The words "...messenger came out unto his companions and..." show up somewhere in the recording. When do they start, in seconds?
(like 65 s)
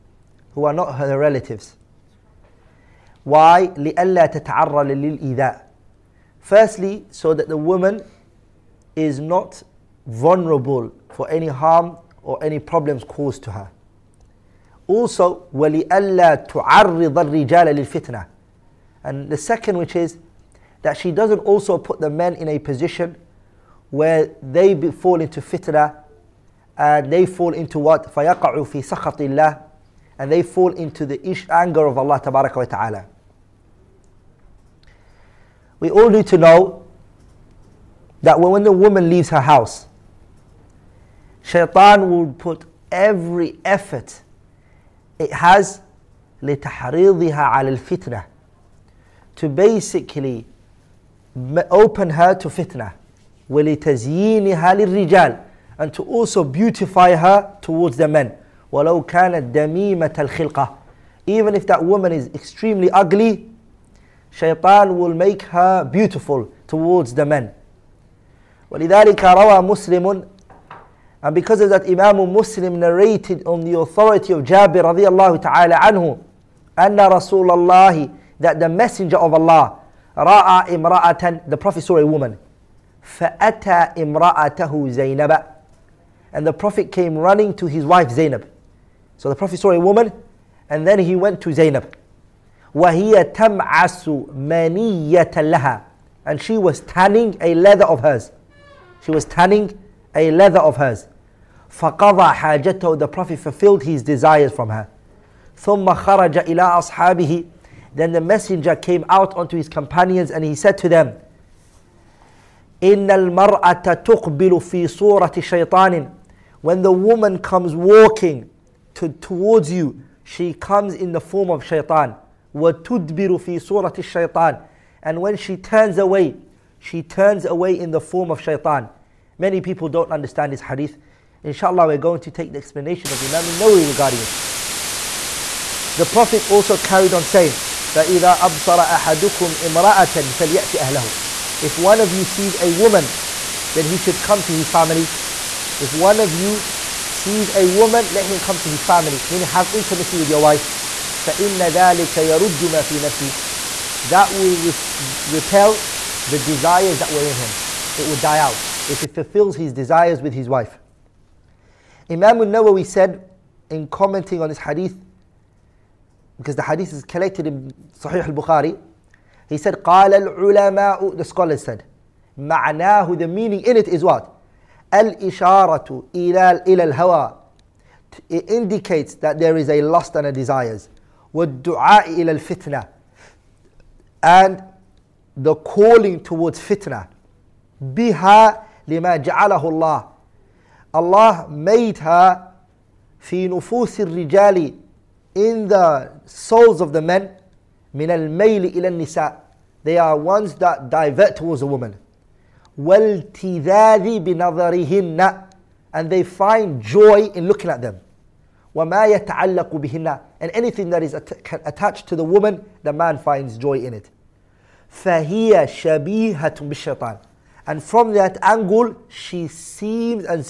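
108 s.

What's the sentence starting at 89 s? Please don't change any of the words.
So the Prophet saw a woman and then he went to Zainab.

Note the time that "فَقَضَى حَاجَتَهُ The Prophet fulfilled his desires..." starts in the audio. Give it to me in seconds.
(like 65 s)
101 s.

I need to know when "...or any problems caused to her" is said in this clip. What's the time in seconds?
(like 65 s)
12 s.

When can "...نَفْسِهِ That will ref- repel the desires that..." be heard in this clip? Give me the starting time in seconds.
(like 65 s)
153 s.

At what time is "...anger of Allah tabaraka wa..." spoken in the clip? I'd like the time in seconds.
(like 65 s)
31 s.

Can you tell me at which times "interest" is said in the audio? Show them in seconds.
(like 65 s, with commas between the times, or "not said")
not said.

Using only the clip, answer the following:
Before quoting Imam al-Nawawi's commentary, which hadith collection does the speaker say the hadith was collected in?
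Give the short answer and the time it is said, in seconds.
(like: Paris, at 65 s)
Sahih al-Bukhari, at 167 s.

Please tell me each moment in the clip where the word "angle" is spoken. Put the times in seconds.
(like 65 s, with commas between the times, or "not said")
218 s.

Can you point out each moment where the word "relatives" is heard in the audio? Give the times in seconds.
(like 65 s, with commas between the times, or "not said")
1 s.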